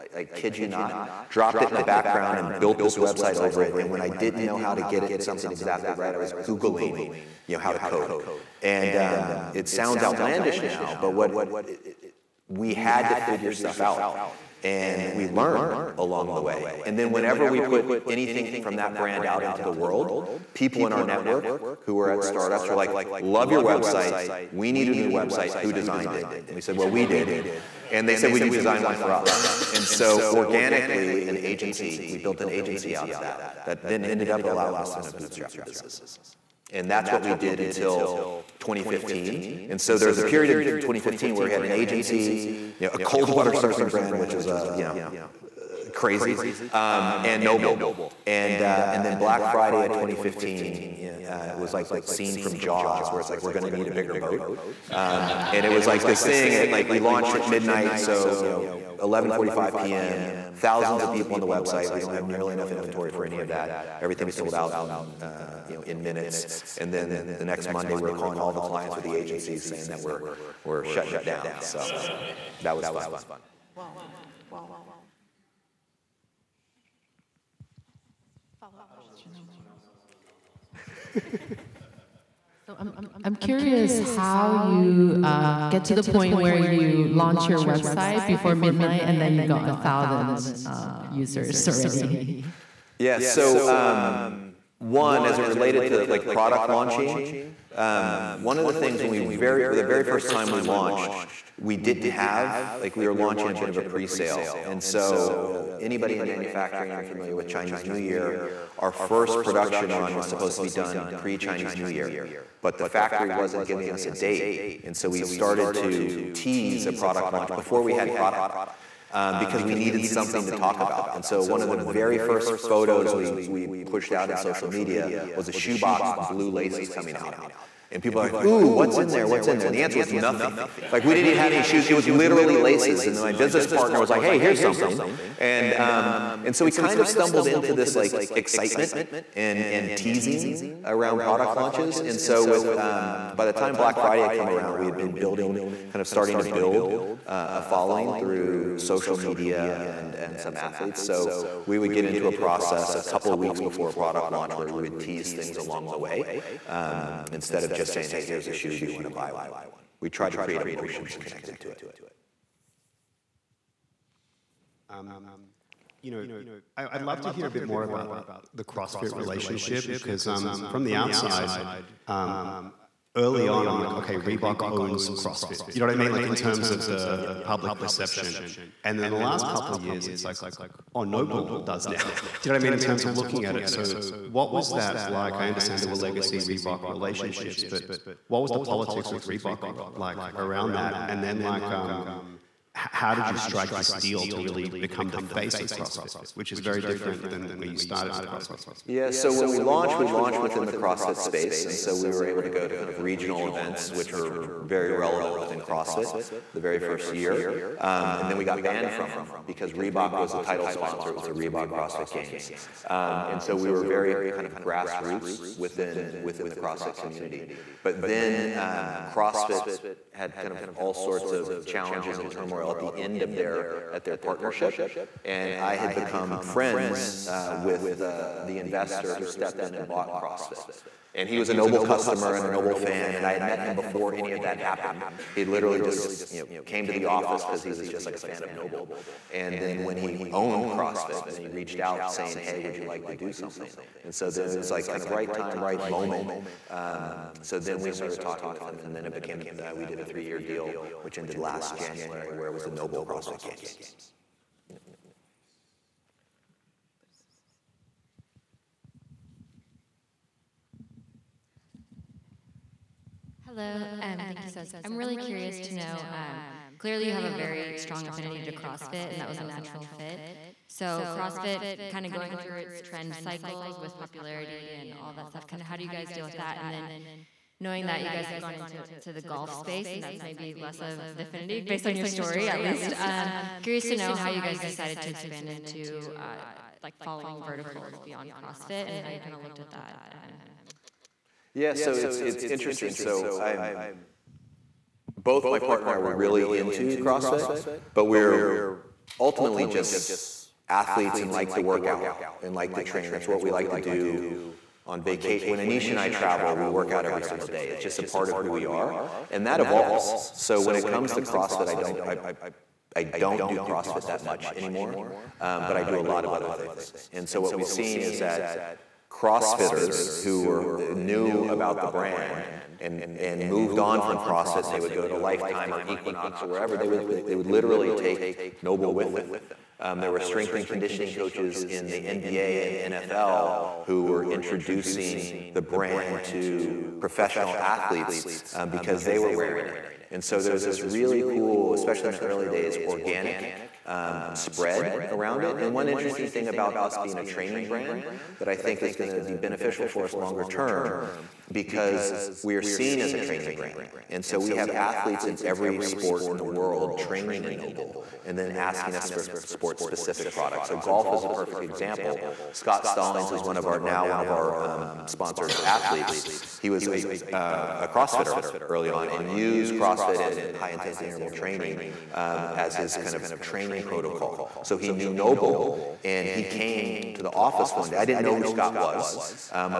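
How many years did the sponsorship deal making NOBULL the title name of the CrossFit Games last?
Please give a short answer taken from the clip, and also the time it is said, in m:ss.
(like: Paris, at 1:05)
3, at 4:10.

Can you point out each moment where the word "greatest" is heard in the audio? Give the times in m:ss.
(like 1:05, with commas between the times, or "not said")
not said.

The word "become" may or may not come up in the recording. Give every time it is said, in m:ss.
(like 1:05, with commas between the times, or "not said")
3:14, 3:45.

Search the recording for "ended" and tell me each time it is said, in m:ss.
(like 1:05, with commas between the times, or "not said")
0:34, 4:11.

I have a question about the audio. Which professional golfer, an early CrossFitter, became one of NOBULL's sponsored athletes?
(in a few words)
Scott Stallings.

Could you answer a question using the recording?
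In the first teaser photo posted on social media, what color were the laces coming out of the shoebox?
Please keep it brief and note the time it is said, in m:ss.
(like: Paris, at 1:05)
Blue, at 2:06.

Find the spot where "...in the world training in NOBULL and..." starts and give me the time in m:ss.
5:56.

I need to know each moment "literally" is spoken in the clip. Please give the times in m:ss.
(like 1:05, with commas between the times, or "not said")
2:12, 3:55, 5:27.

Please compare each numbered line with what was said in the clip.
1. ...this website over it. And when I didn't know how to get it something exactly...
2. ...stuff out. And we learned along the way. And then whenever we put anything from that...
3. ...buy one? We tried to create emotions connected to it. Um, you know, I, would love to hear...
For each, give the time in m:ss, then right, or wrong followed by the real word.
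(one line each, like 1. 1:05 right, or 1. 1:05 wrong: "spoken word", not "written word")
1. 0:02 right
2. 0:13 right
3. 2:39 right.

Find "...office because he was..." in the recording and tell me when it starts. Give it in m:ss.
3:57.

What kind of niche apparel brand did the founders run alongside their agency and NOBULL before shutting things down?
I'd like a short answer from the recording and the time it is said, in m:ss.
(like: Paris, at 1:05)
cold water surfing brand, at 0:42.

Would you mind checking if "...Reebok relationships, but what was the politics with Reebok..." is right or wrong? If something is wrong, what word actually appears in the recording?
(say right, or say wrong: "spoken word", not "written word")
right.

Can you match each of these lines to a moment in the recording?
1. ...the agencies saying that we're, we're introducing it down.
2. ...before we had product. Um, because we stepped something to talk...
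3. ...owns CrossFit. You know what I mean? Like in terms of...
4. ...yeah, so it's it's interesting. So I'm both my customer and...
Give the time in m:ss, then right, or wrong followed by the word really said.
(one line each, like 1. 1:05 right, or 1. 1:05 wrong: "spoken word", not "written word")
1. 1:09 wrong: "shutting", not "introducing"
2. 1:57 wrong: "needed", not "stepped"
3. 2:54 right
4. 4:51 wrong: "partner", not "customer".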